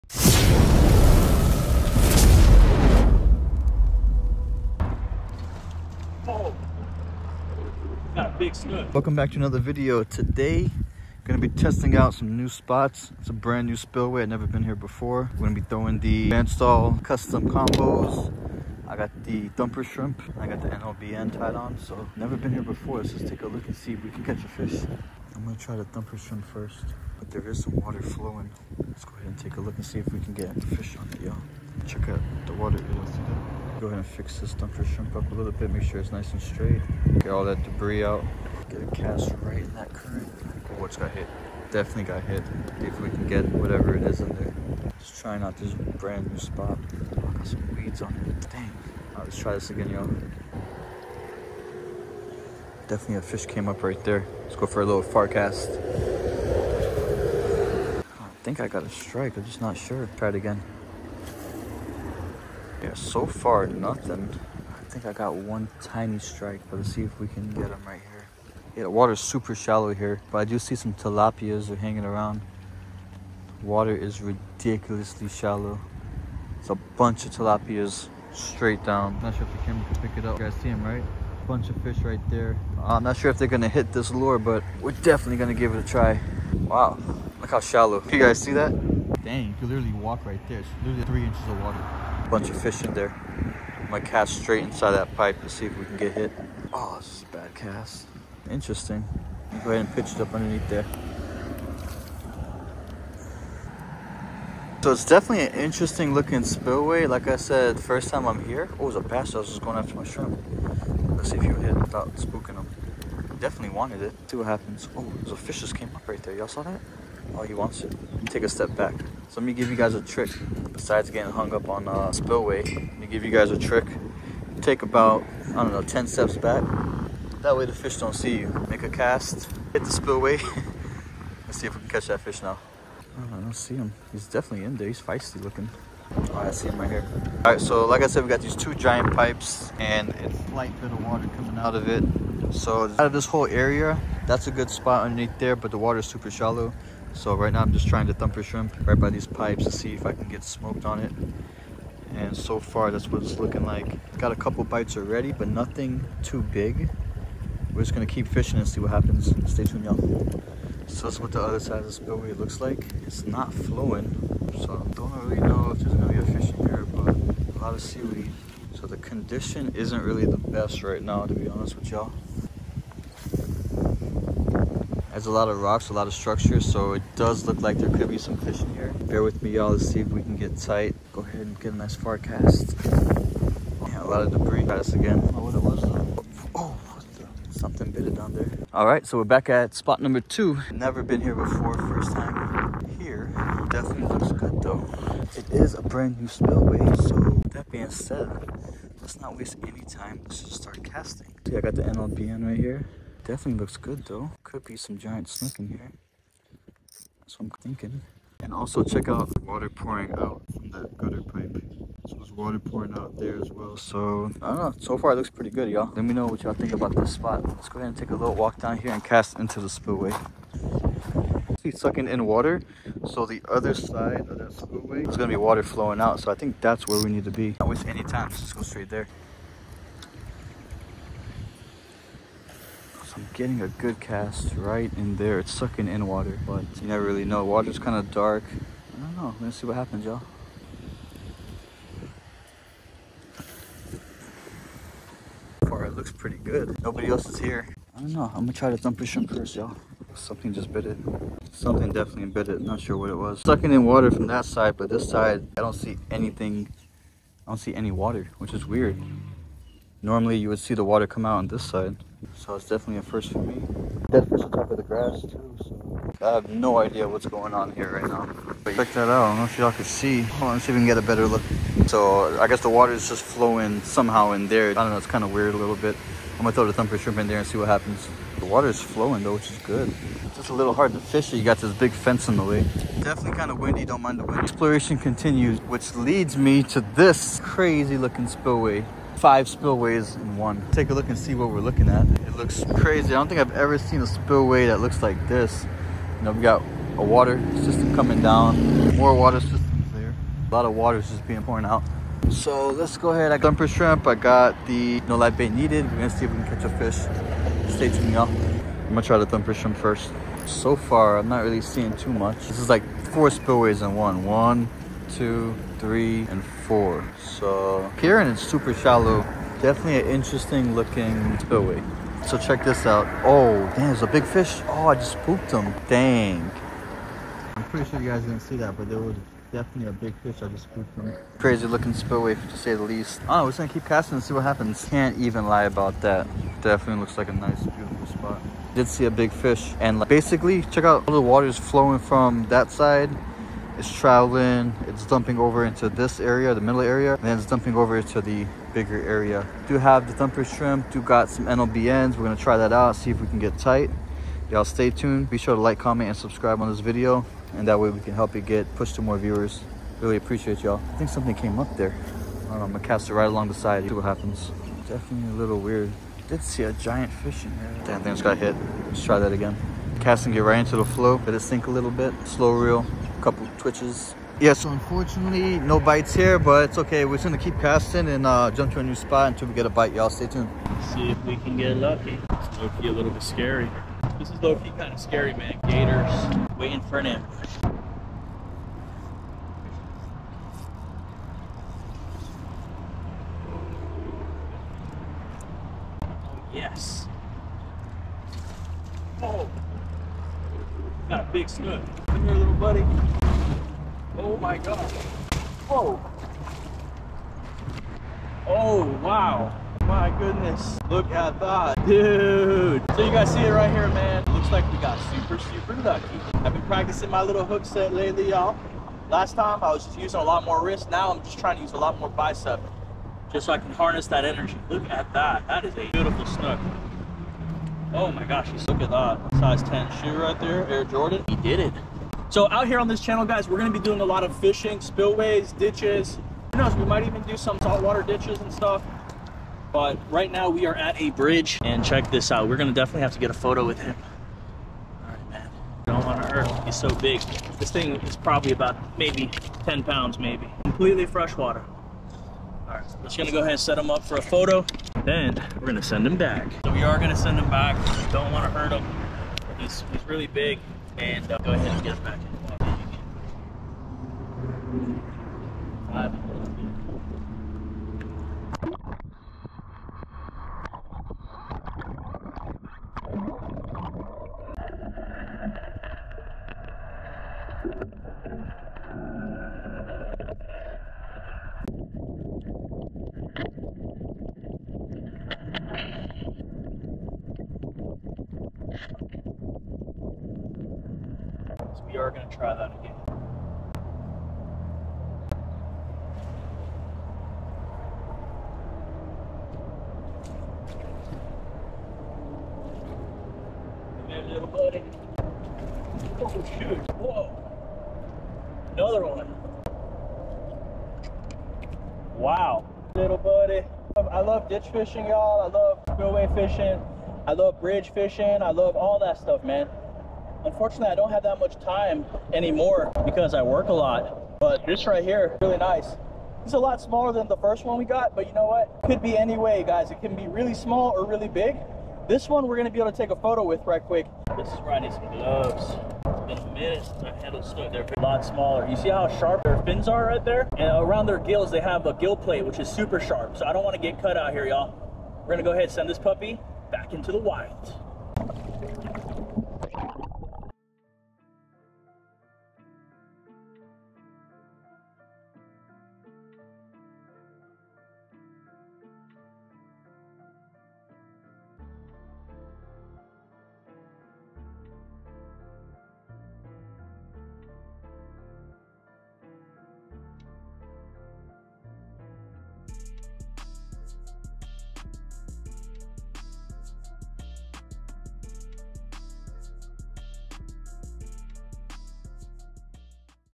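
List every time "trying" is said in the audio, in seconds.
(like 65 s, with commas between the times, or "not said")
45 s, 147 s, 421 s.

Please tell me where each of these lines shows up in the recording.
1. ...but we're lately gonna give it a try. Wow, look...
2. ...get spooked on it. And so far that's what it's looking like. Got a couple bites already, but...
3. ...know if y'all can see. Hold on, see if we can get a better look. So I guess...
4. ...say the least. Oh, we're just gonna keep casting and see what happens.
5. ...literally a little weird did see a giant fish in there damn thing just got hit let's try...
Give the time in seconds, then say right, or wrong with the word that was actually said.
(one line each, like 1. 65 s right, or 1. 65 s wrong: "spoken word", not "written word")
1. 84 s wrong: "definitely", not "lately"
2. 150 s wrong: "smoked", not "spooked"
3. 269 s right
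4. 332 s right
5. 364 s wrong: "definitely", not "literally".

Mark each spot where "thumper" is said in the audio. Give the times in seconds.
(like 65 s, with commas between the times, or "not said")
19 s, 25 s, 34 s, 148 s, 276 s, 303 s, 309 s, 350 s.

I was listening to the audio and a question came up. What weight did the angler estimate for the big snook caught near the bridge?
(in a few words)
10 pounds.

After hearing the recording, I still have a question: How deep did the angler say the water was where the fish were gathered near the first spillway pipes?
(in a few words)
3 inches.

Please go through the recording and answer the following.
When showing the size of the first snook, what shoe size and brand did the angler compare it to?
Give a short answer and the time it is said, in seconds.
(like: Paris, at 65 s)
Size 10 Air Jordan, at 429 s.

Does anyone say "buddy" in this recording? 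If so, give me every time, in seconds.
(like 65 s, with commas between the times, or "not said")
402 s, 504 s, 513 s.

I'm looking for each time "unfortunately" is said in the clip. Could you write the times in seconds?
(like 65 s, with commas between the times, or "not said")
374 s, 520 s.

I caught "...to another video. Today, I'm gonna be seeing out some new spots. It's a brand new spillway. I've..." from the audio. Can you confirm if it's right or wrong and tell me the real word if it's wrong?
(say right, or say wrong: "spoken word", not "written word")
wrong: "testing", not "seeing".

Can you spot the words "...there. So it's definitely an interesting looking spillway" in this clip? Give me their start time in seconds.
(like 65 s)
100 s.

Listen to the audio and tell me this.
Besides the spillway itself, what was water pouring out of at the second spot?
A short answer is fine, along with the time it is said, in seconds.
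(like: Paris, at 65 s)
Gutter pipe, at 210 s.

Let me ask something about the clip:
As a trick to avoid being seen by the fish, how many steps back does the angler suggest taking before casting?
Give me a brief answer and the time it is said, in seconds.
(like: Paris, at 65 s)
10, at 125 s.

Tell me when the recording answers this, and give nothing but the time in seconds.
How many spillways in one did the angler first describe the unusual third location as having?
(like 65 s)
289 s.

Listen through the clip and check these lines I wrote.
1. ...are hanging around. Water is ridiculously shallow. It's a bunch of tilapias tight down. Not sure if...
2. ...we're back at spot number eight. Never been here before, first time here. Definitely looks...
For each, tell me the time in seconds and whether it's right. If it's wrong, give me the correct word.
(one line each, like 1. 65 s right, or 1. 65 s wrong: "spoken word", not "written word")
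1. 71 s wrong: "straight", not "tight"
2. 189 s wrong: "two", not "eight".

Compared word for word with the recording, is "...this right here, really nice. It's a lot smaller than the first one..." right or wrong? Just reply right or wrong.
right.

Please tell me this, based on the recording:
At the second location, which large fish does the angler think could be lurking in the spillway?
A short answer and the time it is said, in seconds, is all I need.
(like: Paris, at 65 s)
Giant snook, at 204 s.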